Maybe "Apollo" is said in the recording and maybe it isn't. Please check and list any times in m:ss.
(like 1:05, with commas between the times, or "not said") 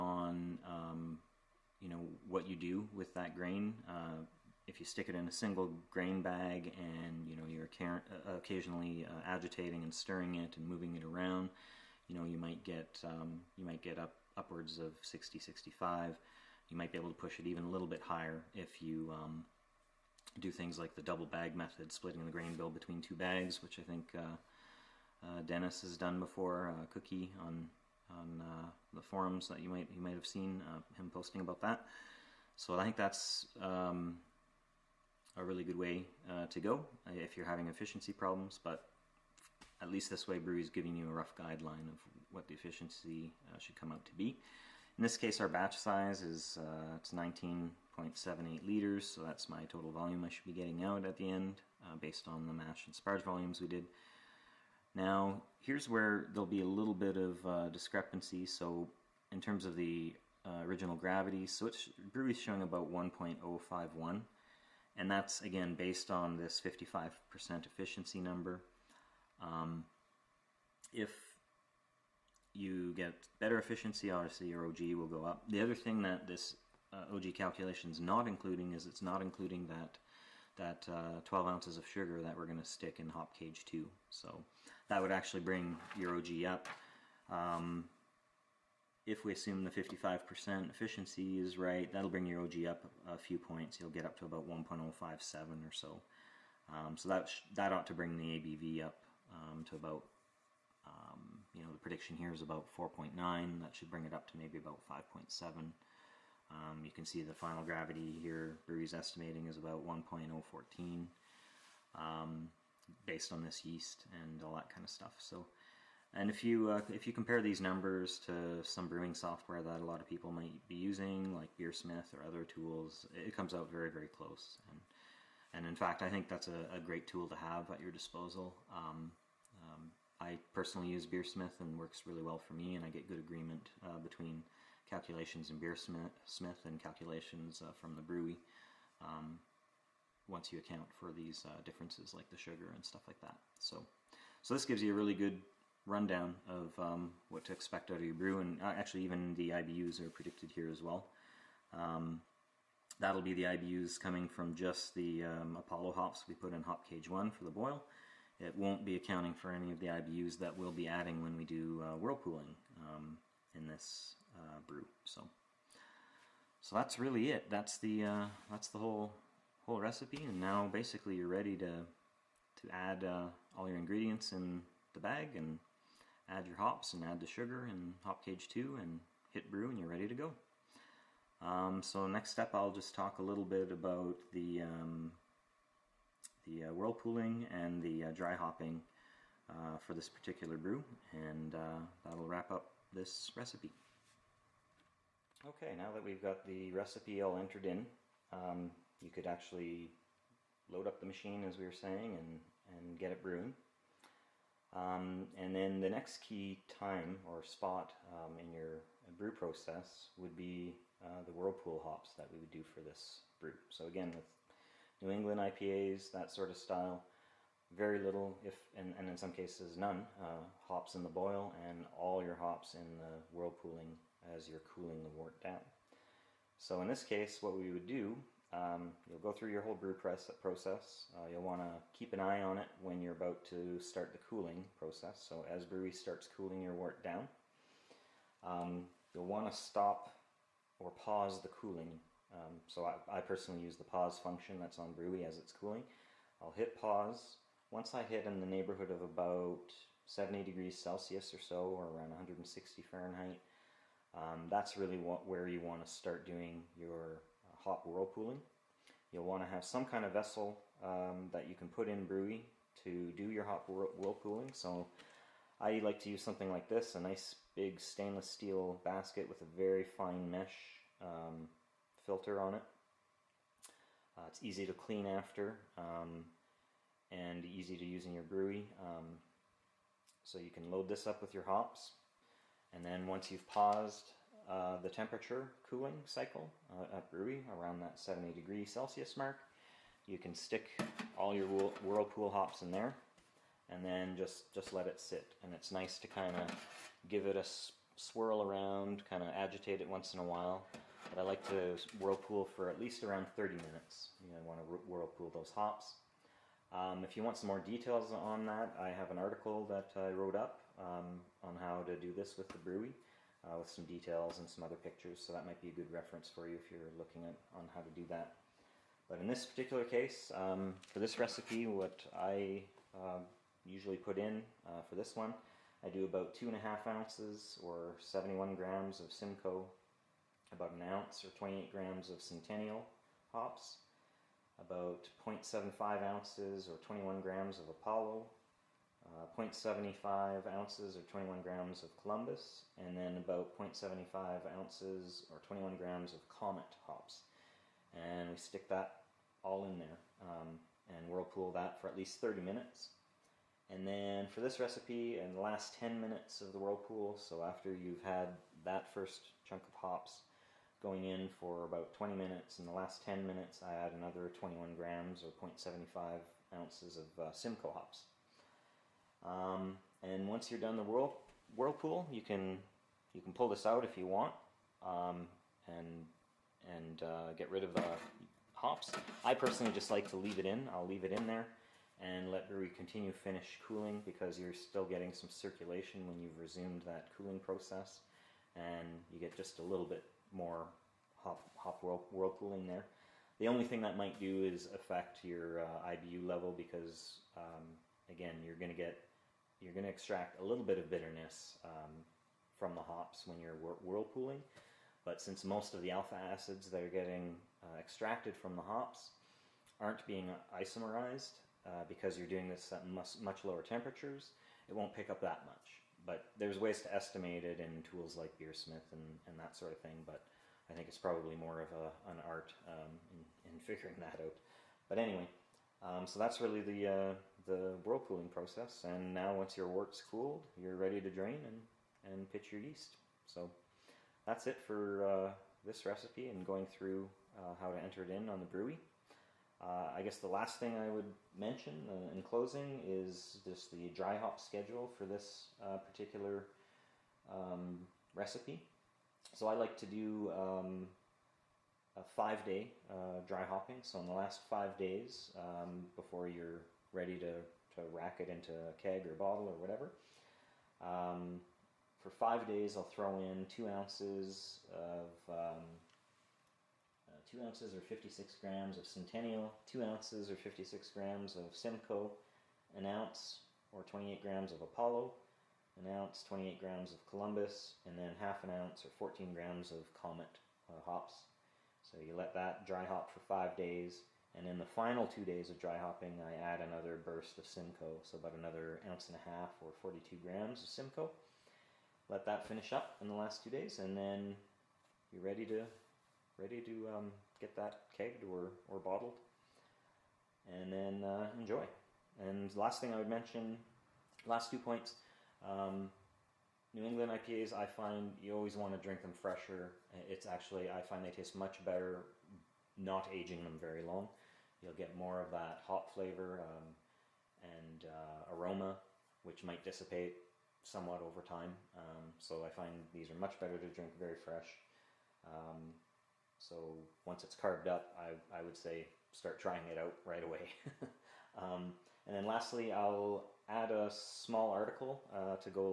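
2:35, 5:37, 7:54.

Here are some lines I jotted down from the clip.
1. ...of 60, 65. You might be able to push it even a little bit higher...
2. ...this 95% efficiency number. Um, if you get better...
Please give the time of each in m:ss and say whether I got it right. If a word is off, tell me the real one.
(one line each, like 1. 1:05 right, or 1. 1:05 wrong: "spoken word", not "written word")
1. 0:14 right
2. 1:06 wrong: "55", not "95".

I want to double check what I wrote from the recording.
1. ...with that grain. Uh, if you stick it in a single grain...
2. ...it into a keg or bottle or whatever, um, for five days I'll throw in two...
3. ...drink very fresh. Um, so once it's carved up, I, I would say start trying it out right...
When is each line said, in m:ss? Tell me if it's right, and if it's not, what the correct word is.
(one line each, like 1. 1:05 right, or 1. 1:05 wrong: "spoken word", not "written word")
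1. 0:02 right
2. 7:38 right
3. 8:43 right.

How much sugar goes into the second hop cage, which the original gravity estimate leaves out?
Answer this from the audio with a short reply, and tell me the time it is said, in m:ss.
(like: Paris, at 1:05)
12 ounces, at 1:21.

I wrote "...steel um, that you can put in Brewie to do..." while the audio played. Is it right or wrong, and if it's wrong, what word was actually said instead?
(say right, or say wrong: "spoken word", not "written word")
wrong: "vessel", not "steel".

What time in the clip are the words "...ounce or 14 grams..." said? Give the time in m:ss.
7:58.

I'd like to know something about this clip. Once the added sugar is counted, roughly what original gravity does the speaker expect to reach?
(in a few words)
1.057.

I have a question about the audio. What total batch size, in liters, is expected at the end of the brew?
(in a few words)
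19.78 liters.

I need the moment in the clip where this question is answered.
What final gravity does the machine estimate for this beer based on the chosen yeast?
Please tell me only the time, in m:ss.
1:49.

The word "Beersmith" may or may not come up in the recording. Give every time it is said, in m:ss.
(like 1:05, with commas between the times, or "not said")
2:01, 2:11, 2:15, 6:58.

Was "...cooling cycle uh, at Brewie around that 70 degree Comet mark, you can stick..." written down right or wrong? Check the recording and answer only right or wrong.
wrong.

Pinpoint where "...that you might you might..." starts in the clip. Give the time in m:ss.
0:29.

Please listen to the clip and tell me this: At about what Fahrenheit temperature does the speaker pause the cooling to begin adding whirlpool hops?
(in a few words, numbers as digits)
160 Fahrenheit.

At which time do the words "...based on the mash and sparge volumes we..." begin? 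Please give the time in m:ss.
0:51.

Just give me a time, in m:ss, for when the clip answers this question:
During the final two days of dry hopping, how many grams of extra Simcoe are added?
8:09.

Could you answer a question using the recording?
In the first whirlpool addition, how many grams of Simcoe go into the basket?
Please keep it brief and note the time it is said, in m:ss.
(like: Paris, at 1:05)
71 grams, at 5:27.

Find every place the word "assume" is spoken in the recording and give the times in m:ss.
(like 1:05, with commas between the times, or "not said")
1:29.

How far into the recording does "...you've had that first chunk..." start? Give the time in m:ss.
5:57.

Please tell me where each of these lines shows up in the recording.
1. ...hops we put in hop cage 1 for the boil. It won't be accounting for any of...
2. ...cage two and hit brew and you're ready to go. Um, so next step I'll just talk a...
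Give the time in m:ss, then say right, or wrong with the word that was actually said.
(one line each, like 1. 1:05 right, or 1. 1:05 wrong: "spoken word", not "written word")
1. 2:35 right
2. 2:58 right.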